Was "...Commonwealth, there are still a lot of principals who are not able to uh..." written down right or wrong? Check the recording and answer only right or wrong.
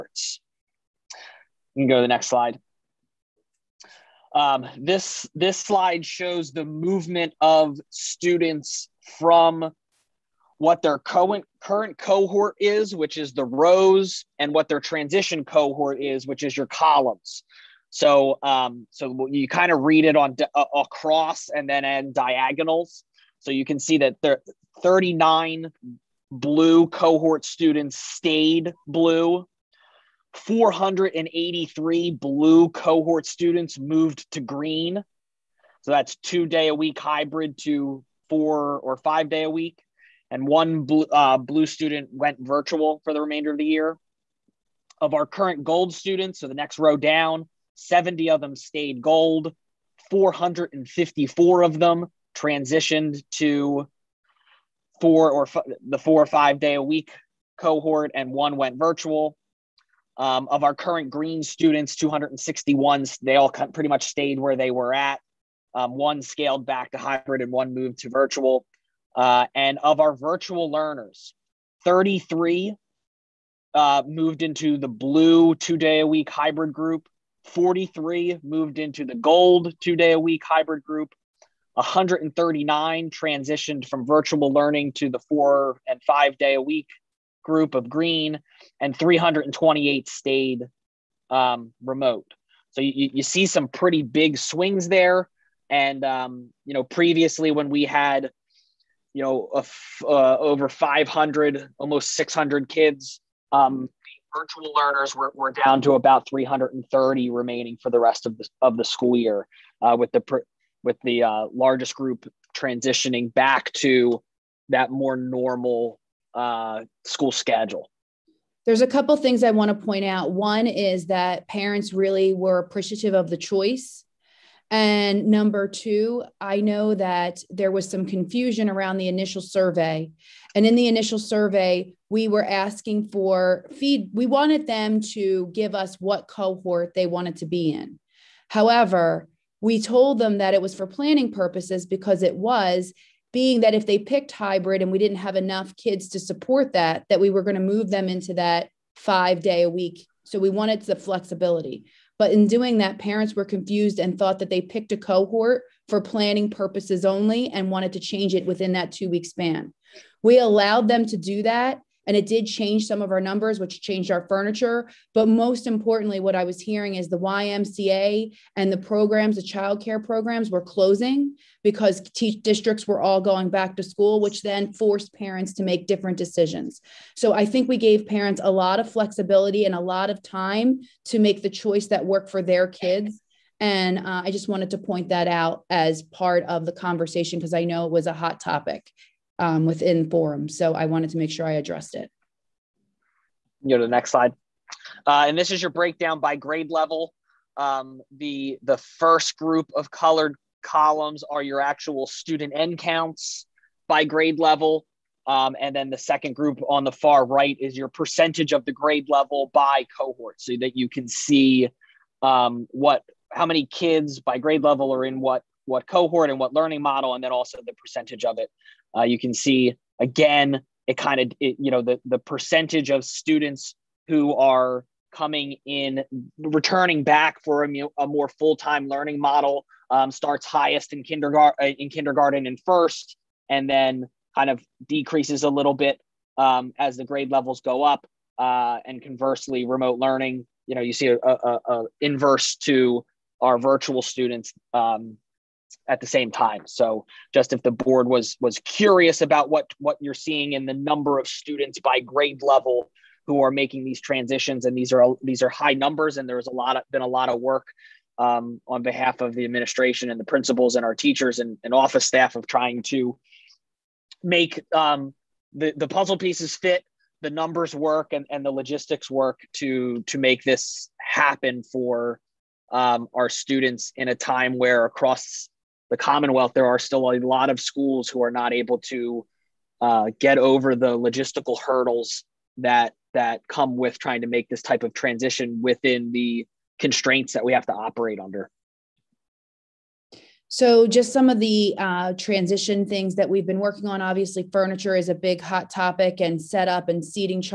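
wrong.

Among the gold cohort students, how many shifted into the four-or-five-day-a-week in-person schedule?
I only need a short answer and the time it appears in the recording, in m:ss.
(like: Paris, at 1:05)
454, at 0:50.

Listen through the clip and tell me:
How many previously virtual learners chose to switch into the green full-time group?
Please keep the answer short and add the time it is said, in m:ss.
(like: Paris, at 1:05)
139, at 1:21.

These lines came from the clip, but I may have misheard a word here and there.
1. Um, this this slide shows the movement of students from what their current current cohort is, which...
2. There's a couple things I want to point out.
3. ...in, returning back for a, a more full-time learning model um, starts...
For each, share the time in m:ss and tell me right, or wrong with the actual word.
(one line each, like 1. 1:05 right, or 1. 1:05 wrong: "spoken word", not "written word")
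1. 0:04 right
2. 1:58 right
3. 3:45 right.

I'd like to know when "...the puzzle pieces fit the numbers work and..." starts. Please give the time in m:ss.
4:25.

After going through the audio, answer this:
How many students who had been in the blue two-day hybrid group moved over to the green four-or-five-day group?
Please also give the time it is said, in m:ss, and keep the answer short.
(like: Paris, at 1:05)
483, at 0:30.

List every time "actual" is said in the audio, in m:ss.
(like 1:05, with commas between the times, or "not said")
3:21.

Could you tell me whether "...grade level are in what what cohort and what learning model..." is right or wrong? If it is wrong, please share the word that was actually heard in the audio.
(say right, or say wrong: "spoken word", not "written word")
right.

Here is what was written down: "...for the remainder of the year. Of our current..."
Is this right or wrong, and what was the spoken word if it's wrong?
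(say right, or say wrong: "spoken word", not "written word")
right.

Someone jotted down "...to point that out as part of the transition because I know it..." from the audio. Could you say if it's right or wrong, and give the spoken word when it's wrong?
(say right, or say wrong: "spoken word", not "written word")
wrong: "conversation", not "transition".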